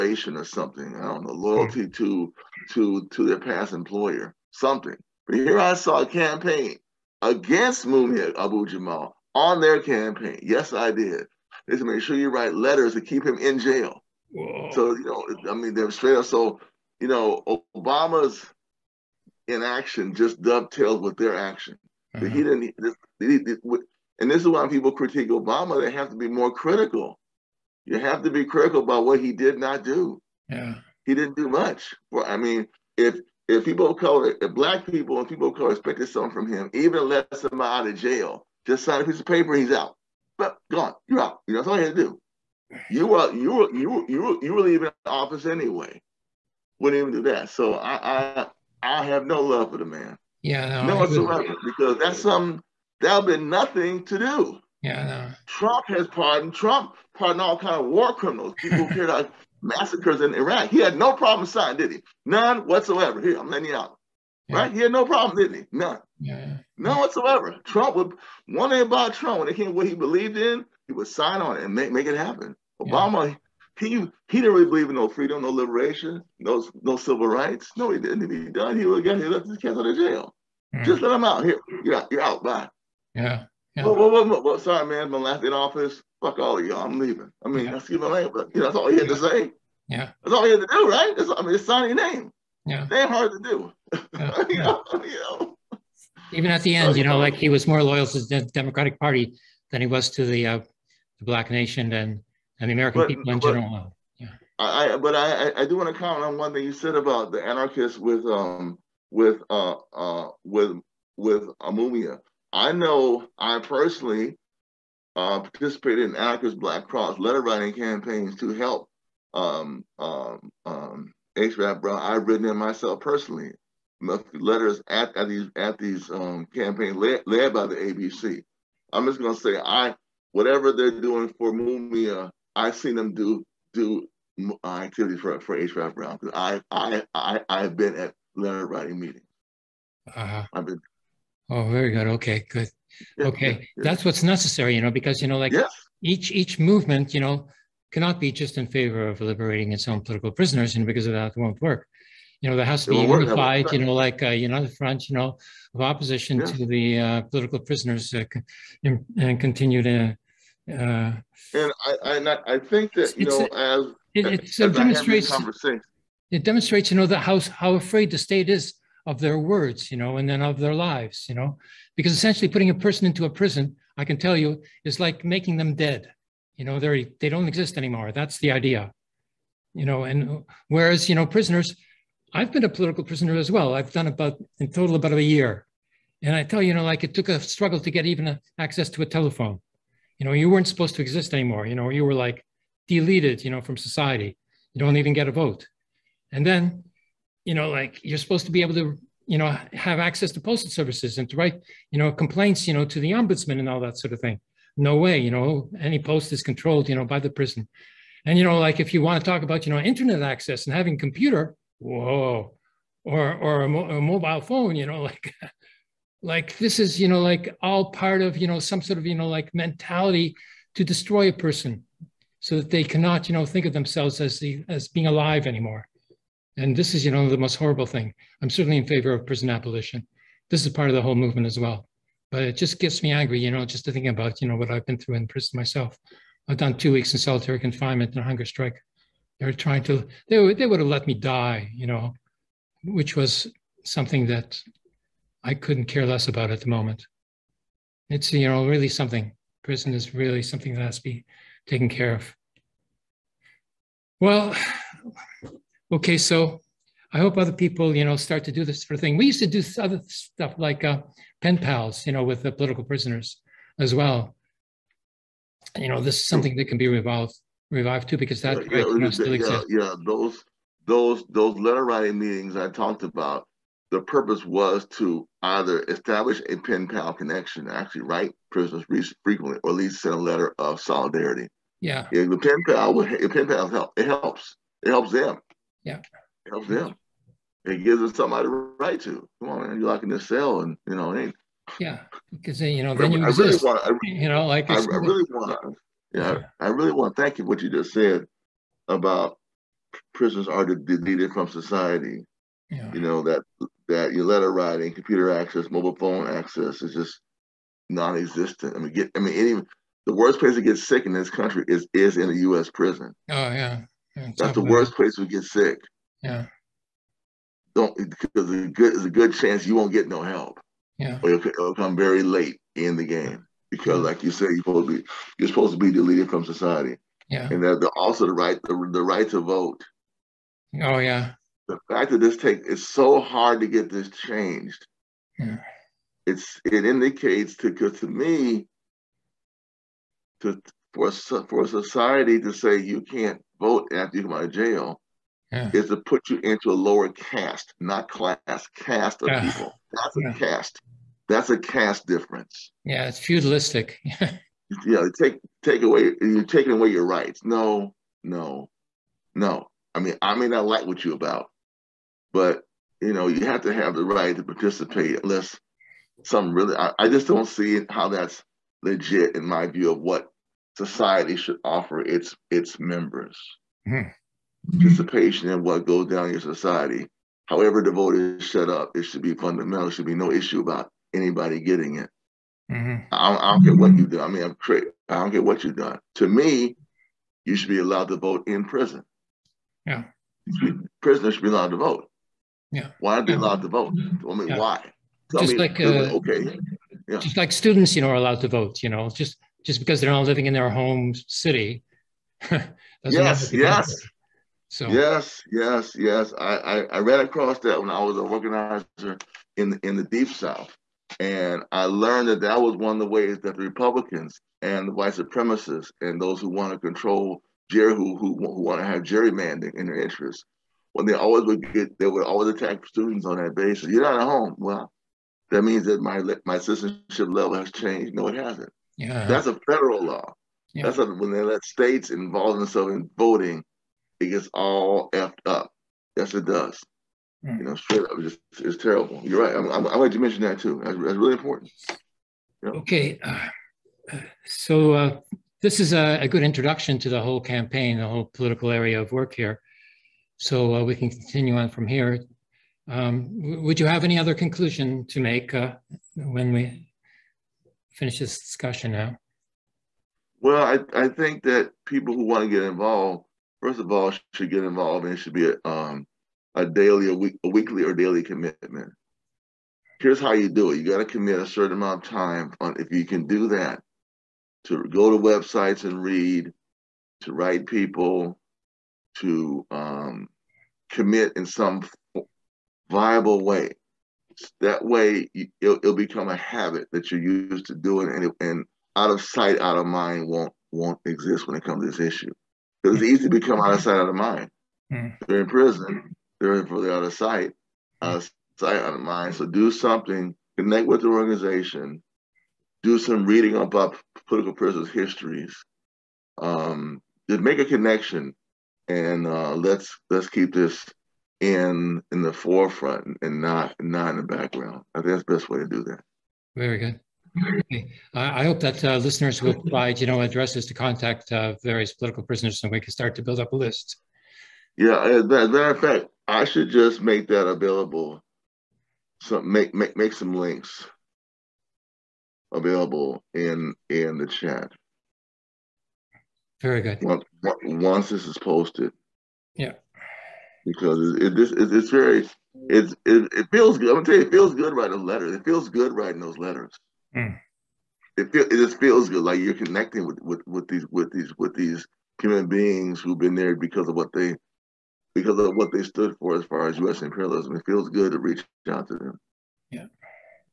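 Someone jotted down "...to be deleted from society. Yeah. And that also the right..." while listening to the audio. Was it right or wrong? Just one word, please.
right.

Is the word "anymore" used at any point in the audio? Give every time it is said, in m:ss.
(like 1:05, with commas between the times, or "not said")
2:57, 3:11, 3:45.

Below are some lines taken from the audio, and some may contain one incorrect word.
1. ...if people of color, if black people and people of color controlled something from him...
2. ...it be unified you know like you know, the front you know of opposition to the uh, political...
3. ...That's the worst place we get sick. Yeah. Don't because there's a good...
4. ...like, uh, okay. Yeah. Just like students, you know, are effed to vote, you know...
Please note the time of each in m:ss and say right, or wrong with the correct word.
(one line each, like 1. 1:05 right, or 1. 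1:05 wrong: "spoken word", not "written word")
1. 0:33 wrong: "expected", not "controlled"
2. 2:32 right
3. 5:14 right
4. 6:35 wrong: "allowed", not "effed".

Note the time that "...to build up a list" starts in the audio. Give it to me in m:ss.
8:43.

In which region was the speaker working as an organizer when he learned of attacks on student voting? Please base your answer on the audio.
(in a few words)
the Deep South.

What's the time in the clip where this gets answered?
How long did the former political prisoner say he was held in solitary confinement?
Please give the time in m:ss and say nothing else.
3:56.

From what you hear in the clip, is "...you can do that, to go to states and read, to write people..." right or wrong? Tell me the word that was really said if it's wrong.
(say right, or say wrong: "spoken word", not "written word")
wrong: "websites", not "states".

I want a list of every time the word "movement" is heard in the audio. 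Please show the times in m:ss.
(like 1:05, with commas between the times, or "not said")
2:26, 3:51.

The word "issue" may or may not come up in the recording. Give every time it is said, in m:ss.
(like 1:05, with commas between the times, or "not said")
6:20, 8:11.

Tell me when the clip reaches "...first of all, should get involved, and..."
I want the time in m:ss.
7:43.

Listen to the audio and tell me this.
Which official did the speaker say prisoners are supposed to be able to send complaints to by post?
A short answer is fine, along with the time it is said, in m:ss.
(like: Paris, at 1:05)
the ombudsman, at 3:22.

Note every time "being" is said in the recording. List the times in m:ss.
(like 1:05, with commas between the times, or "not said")
3:44, 9:12.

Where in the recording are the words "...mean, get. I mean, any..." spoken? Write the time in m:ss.
5:08.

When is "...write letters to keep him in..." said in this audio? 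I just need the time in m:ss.
0:12.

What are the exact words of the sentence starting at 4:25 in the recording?
You know, this is something that can be revived, revived too, because that yeah, yeah, still exists.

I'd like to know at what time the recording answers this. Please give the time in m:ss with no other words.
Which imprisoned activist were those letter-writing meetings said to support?
2:15.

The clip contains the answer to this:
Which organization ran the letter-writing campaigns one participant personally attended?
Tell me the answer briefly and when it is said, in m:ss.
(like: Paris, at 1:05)
Anarchist Black Cross, at 1:56.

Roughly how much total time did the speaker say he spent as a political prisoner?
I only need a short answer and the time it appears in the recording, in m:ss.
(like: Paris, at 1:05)
about a year, at 3:04.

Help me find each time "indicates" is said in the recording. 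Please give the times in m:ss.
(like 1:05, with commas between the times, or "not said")
5:36.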